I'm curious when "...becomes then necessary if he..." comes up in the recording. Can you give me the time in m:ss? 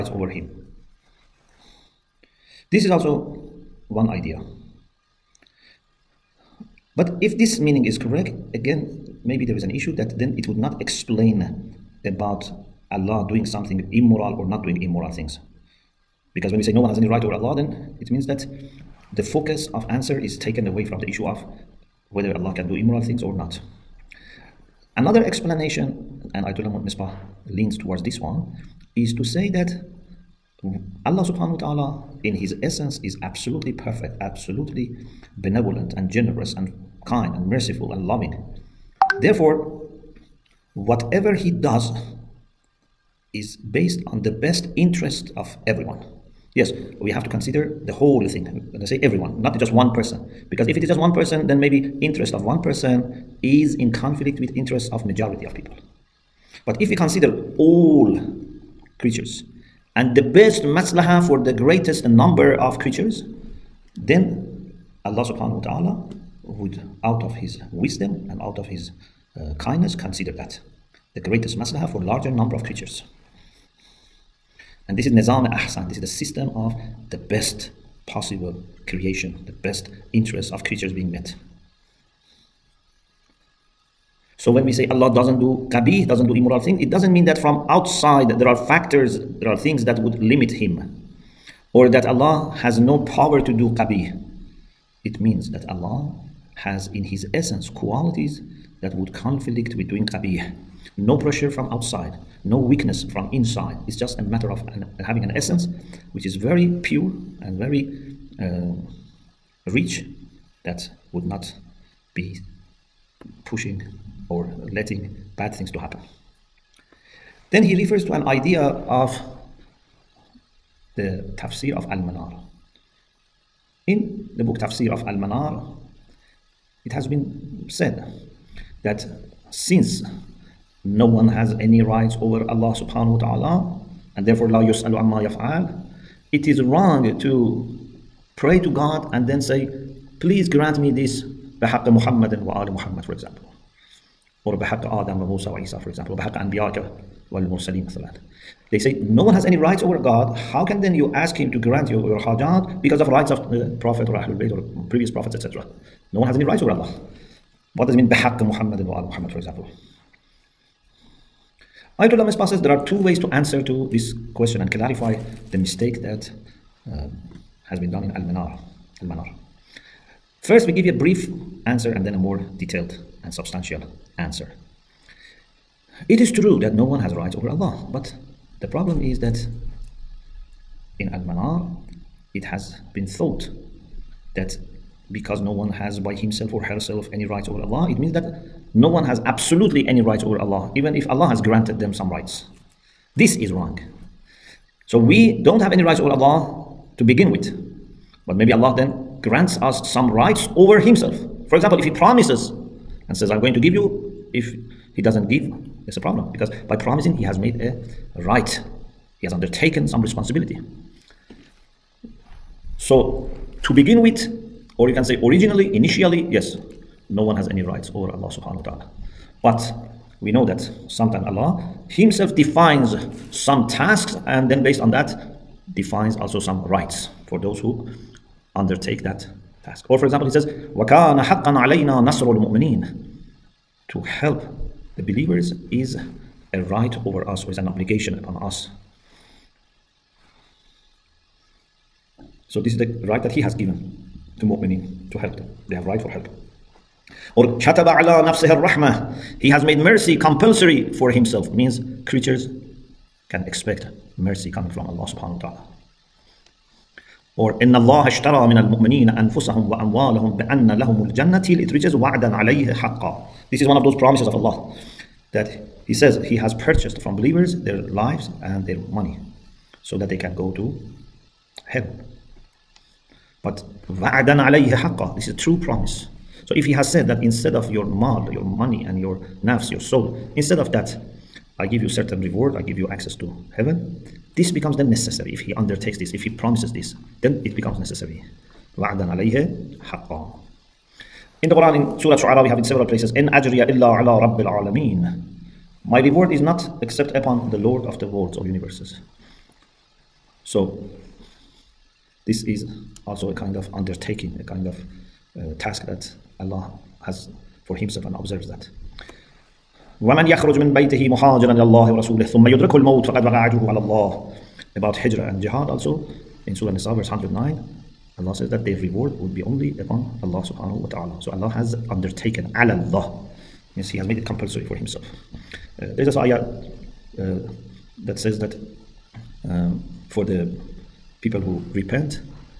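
4:44.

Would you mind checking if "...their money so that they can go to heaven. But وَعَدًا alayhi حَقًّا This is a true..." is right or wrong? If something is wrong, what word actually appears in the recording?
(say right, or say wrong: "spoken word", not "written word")
right.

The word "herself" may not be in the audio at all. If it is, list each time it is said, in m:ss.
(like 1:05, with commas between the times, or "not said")
3:06.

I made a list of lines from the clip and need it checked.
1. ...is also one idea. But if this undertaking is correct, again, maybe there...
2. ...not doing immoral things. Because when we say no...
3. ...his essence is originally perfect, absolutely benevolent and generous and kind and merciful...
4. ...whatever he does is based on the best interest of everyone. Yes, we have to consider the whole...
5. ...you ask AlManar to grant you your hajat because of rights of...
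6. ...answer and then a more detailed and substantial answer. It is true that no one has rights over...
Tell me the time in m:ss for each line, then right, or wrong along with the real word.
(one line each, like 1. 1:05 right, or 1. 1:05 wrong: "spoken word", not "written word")
1. 0:02 wrong: "meaning", not "undertaking"
2. 0:14 right
3. 0:32 wrong: "absolutely", not "originally"
4. 0:40 right
5. 2:30 wrong: "Him", not "AlManar"
6. 2:51 right.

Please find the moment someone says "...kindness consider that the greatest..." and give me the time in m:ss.
1:09.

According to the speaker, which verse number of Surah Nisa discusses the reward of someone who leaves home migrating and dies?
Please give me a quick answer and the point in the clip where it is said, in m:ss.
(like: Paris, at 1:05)
109, at 5:16.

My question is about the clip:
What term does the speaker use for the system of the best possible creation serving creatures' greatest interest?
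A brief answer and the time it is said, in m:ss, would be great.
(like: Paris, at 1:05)
Nizam Ahsan, at 1:15.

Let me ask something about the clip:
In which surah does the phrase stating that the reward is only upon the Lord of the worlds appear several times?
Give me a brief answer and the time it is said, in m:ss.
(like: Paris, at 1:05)
Surah Shu'ara, at 4:51.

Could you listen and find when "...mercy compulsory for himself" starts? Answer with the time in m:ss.
4:09.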